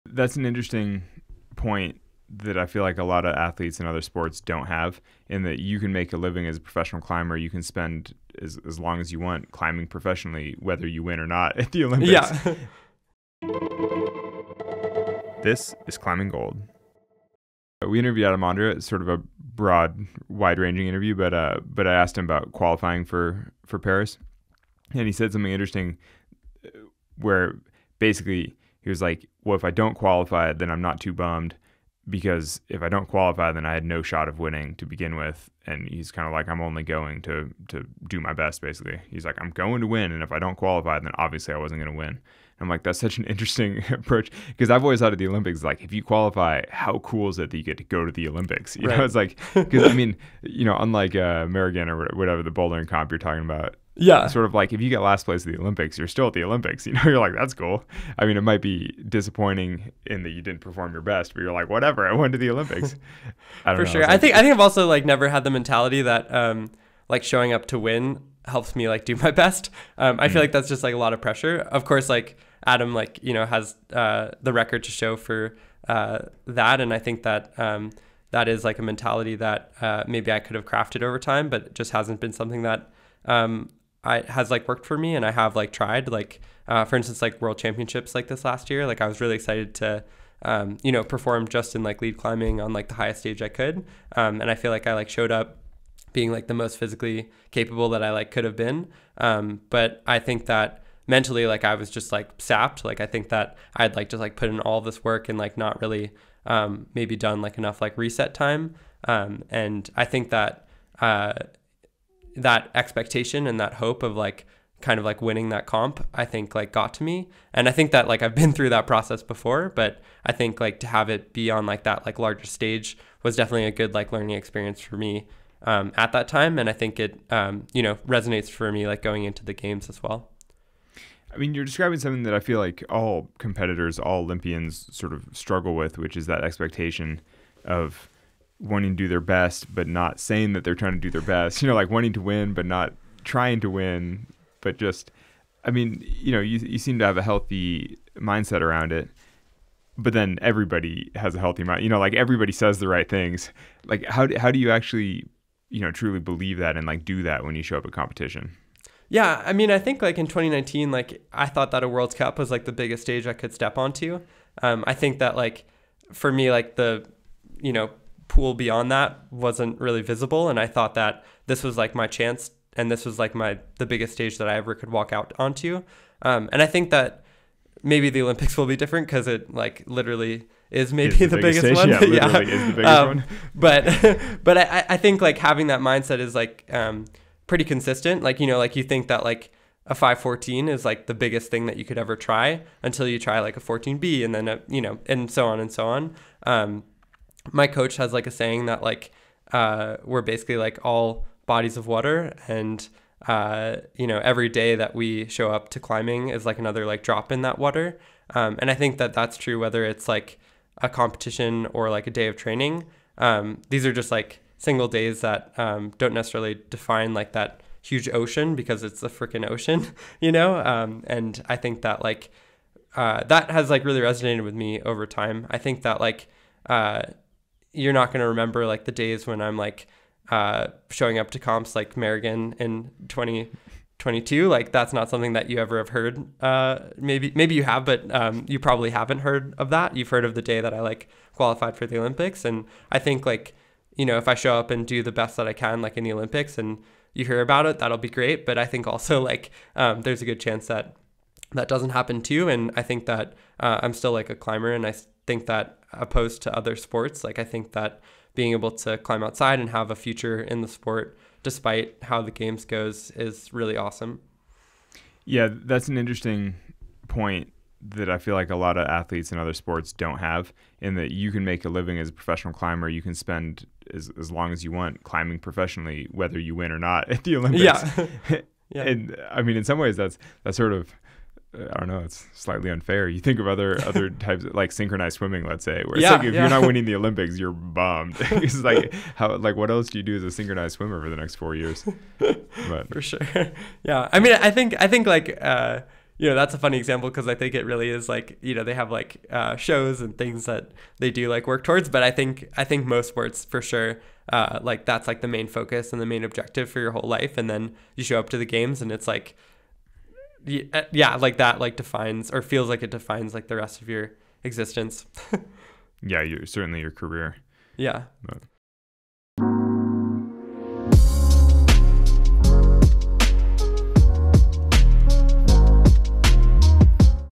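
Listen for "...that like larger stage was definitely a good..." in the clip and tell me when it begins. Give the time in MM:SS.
02:01.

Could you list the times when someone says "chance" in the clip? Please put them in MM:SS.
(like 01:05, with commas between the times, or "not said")
02:52, 04:10.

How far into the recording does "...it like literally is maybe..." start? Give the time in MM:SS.
02:59.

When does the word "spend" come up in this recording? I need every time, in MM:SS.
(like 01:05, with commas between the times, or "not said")
00:07, 04:33.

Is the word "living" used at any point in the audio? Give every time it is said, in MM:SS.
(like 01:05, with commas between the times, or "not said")
00:06, 04:31.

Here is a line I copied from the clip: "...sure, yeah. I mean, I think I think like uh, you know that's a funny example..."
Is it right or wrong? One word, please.
right.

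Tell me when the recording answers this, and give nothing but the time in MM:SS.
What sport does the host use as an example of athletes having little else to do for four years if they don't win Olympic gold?
04:44.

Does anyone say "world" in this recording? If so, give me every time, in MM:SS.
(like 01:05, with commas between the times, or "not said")
01:27, 02:41.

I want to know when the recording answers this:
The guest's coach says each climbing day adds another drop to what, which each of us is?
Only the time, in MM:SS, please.
03:21.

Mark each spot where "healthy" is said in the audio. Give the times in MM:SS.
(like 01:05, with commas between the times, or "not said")
02:27, 02:31.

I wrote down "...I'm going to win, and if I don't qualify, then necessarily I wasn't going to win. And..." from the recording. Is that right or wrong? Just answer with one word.
wrong.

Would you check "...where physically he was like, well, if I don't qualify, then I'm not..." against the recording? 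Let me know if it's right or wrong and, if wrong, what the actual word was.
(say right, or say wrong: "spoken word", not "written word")
wrong: "basically", not "physically".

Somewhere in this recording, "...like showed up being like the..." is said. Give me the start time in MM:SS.
01:34.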